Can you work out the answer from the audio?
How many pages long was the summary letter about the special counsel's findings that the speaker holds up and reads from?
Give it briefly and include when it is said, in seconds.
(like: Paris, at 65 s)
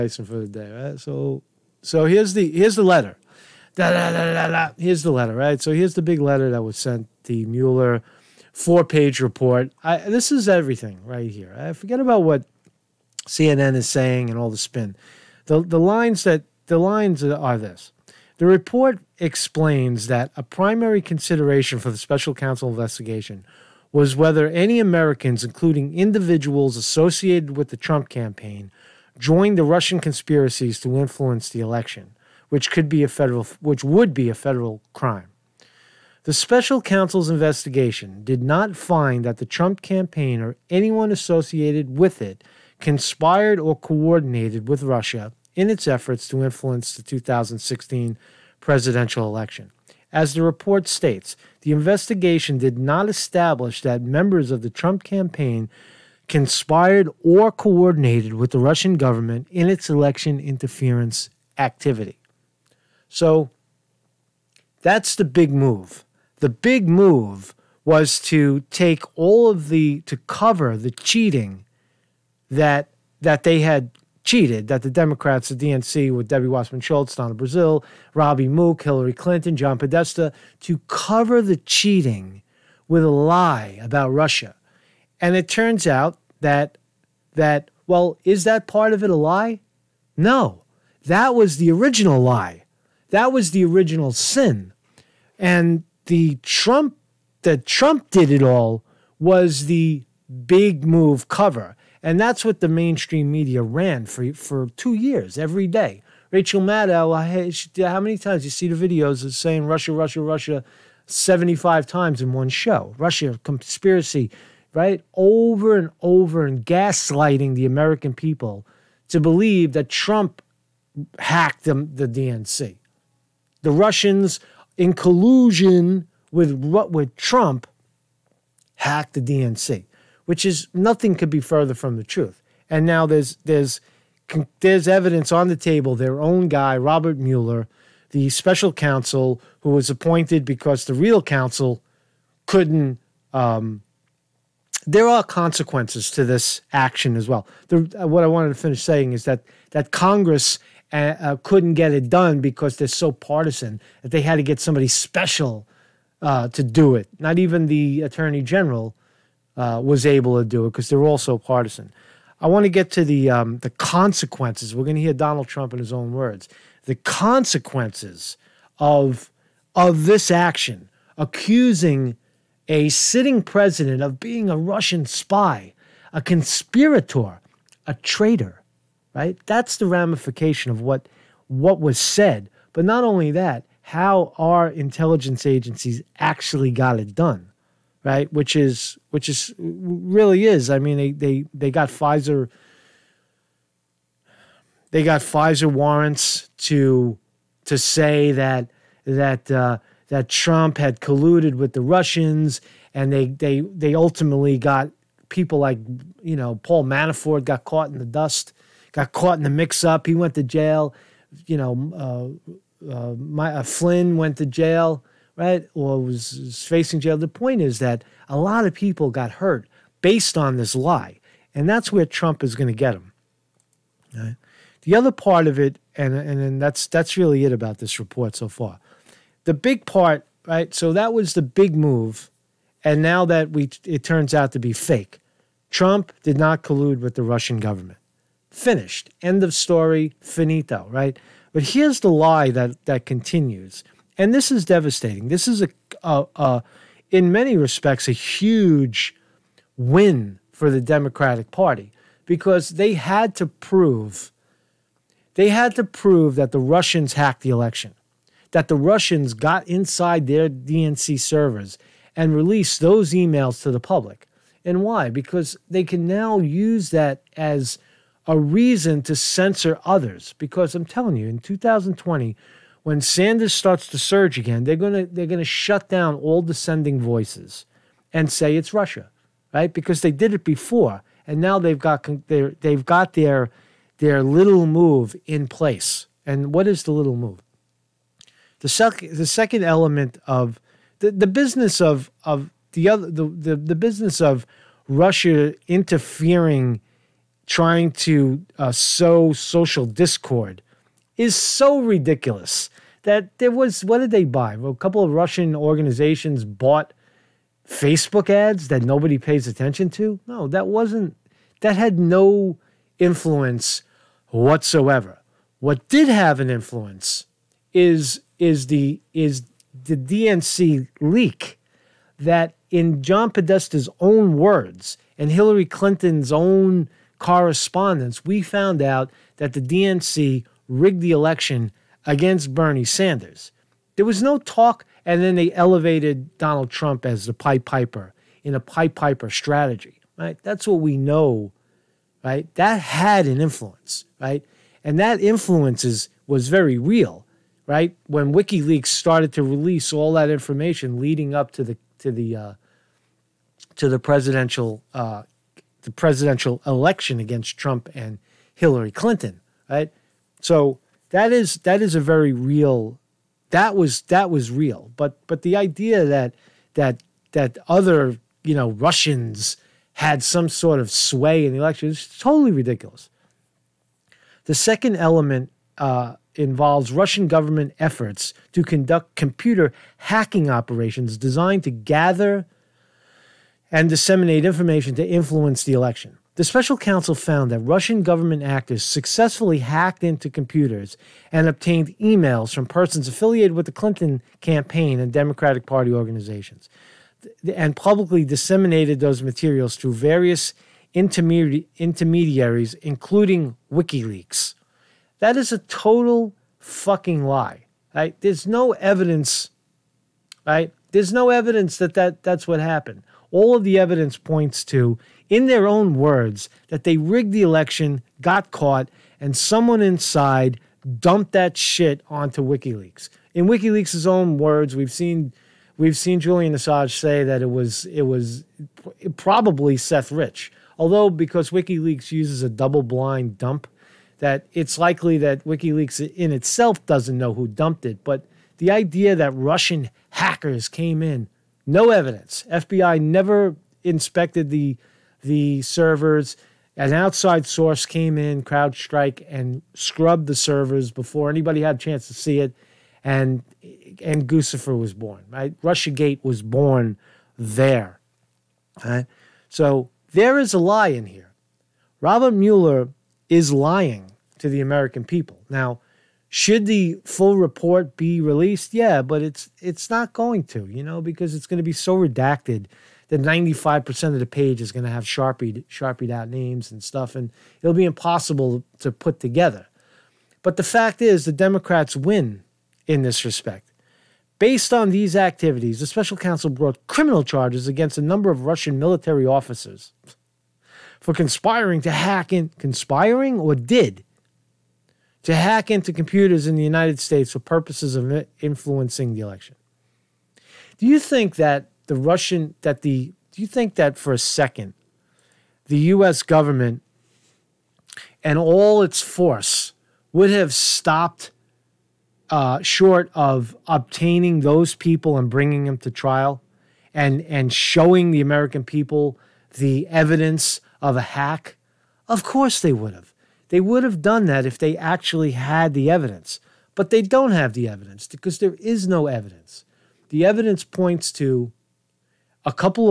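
4, at 8 s.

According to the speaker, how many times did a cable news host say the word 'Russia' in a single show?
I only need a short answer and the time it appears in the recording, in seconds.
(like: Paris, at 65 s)
75, at 111 s.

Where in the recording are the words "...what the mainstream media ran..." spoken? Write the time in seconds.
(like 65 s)
102 s.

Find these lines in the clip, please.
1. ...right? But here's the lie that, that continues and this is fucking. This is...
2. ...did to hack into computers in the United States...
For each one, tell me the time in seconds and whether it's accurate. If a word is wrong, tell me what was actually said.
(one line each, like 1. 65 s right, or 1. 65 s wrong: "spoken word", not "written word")
1. 240 s wrong: "devastating", not "fucking"
2. 493 s right.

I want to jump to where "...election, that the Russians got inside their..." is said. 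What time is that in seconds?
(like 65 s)
257 s.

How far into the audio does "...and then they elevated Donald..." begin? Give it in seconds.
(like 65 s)
335 s.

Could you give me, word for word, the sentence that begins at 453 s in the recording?
And and Guccifer was born, right?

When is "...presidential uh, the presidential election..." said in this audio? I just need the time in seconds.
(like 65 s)
353 s.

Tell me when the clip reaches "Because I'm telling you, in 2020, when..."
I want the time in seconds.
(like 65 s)
270 s.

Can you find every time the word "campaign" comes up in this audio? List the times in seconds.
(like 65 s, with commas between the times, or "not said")
28 s, 39 s, 55 s, 394 s.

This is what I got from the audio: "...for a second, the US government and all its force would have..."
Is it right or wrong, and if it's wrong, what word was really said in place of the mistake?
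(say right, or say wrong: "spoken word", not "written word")
right.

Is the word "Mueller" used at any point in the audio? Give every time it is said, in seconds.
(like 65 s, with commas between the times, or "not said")
7 s, 137 s, 462 s.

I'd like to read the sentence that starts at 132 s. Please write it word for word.
And now there's there's there's evidence on the table.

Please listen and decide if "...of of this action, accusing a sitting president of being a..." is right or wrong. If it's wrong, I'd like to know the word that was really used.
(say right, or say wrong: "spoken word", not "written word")
right.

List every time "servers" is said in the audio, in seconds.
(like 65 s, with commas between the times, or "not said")
261 s, 445 s, 450 s.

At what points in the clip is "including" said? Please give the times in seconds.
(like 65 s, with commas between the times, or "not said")
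25 s, 402 s.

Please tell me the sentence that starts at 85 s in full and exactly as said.
And it turns out that that well, is that part of it a lie?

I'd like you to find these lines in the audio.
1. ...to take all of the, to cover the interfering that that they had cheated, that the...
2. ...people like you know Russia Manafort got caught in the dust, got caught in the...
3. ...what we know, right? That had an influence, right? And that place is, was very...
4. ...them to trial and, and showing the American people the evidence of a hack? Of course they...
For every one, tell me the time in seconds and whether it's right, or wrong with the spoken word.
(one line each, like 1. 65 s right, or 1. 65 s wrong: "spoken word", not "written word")
1. 68 s wrong: "cheating", not "interfering"
2. 205 s wrong: "Paul", not "Russia"
3. 340 s wrong: "influence", not "place"
4. 515 s right.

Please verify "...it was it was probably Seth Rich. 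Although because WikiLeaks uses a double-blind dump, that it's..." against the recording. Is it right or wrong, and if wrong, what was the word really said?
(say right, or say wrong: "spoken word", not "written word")
right.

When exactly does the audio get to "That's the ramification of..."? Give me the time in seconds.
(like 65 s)
179 s.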